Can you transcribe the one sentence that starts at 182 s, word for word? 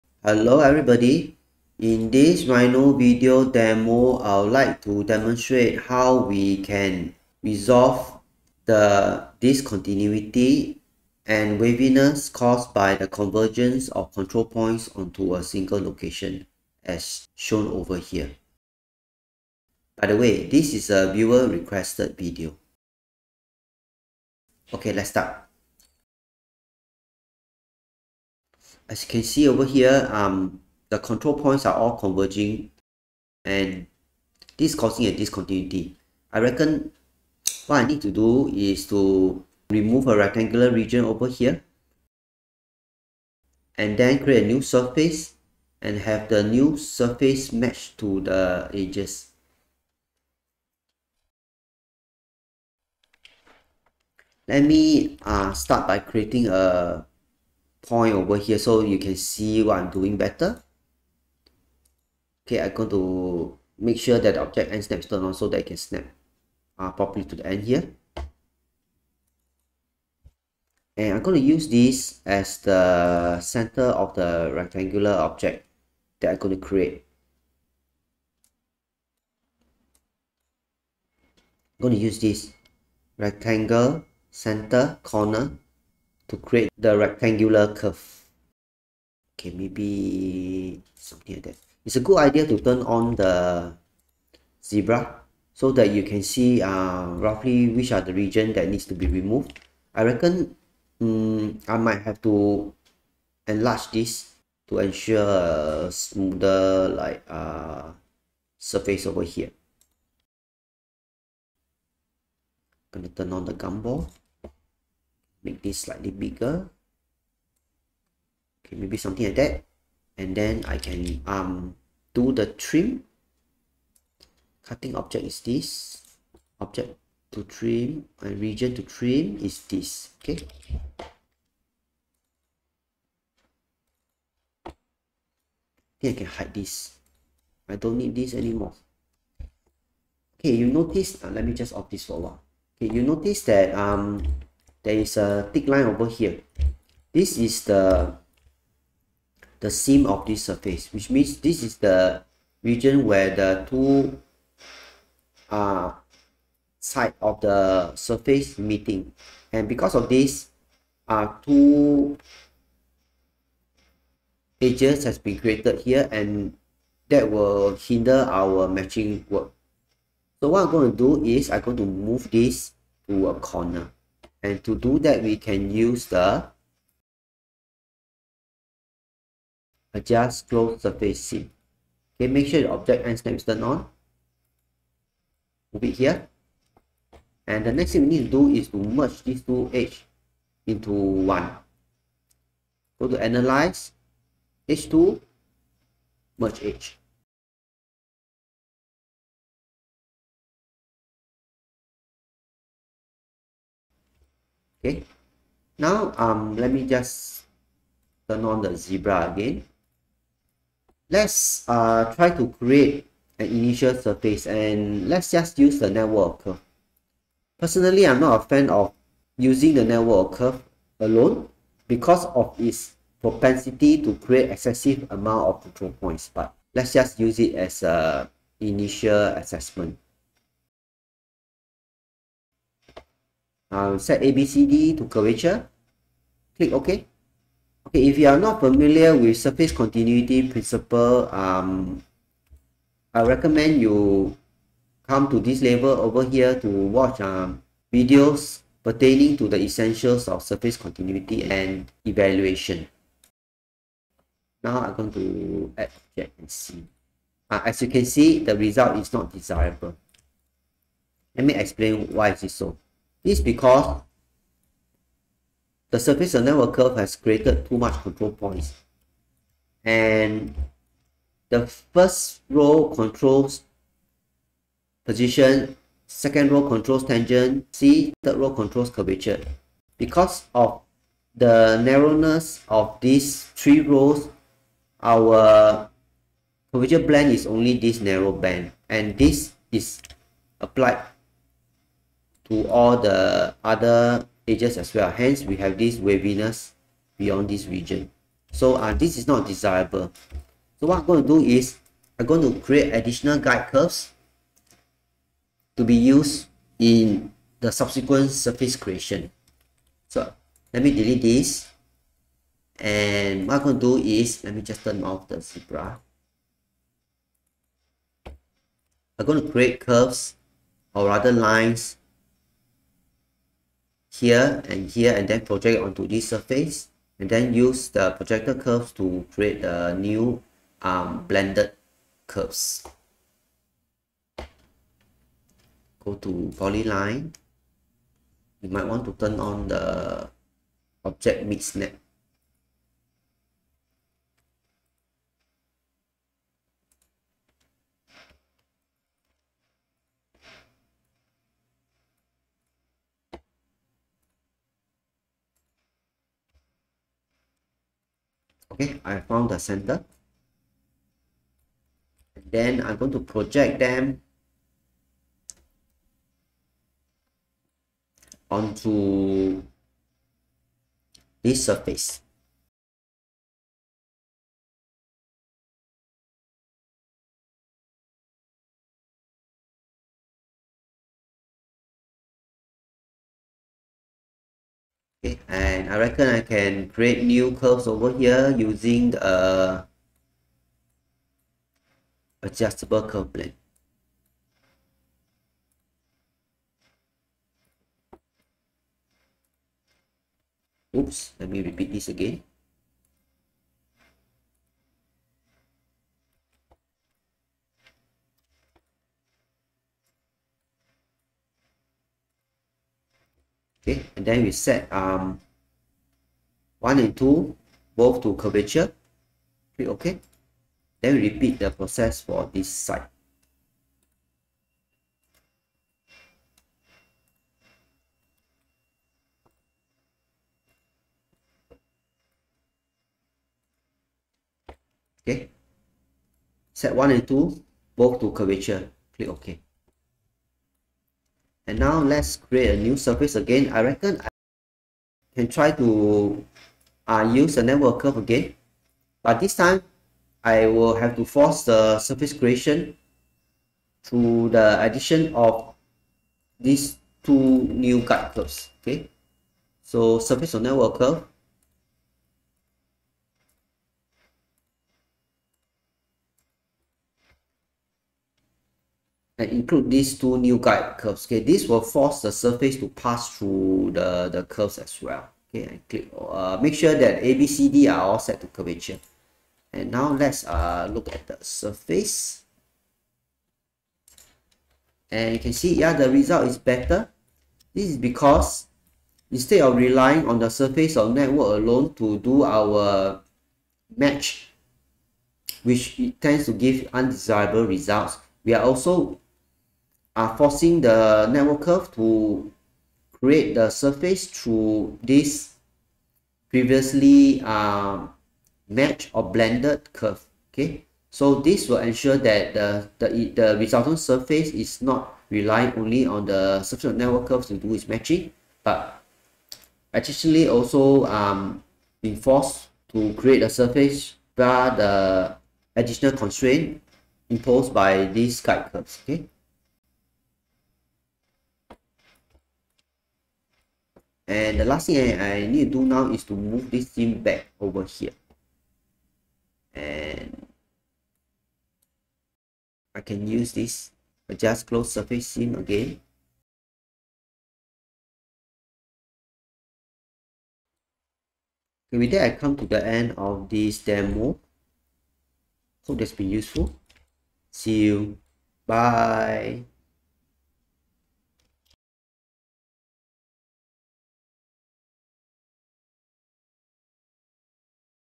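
Okay, make sure the object and snap is turned on.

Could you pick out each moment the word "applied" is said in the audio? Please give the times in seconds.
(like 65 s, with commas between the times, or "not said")
290 s.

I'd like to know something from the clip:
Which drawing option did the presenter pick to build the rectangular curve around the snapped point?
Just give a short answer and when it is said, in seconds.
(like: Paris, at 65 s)
Rectangle center corner, at 83 s.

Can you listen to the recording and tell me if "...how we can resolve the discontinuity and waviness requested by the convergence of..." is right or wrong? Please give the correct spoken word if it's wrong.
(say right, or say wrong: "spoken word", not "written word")
wrong: "caused", not "requested".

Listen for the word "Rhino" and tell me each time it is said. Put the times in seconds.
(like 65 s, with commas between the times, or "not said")
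2 s.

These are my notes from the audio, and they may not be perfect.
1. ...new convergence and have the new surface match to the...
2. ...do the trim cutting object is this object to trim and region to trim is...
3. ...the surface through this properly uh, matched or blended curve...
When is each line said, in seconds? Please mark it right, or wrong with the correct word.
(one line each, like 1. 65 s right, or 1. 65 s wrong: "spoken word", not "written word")
1. 44 s wrong: "surface", not "convergence"
2. 122 s right
3. 503 s wrong: "previously", not "properly".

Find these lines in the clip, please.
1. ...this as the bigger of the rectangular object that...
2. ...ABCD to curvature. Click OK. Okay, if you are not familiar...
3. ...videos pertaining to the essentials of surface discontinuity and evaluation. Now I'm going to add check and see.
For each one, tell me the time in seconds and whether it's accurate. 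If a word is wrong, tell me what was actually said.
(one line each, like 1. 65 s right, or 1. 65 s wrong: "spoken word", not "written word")
1. 71 s wrong: "center", not "bigger"
2. 234 s right
3. 247 s wrong: "continuity", not "discontinuity".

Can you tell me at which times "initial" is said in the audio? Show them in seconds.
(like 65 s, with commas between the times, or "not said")
213 s, 228 s.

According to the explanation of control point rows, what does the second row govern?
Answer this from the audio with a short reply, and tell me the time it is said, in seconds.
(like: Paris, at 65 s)
Tangent, at 277 s.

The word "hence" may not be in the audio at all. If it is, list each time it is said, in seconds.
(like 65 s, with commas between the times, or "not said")
295 s.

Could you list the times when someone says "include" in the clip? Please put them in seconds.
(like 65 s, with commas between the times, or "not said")
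469 s.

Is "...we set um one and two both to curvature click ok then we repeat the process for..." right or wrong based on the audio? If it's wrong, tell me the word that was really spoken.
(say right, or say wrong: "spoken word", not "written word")
right.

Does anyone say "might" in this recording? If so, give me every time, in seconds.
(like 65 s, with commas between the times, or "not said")
101 s, 338 s.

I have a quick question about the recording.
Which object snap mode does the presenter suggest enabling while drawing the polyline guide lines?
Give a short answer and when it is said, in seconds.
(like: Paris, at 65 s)
Mid snap, at 341 s.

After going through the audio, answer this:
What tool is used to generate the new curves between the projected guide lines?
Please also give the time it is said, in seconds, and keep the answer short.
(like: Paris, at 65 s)
Adjustable curve blend, at 392 s.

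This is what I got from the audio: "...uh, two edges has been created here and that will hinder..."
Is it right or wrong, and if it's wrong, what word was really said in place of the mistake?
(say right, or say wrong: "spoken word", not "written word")
right.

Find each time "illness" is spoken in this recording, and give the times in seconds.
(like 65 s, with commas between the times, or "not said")
not said.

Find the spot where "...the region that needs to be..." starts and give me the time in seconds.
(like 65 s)
97 s.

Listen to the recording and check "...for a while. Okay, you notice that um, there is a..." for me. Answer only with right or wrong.
right.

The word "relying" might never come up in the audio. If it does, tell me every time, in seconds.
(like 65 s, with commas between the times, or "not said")
489 s, 515 s.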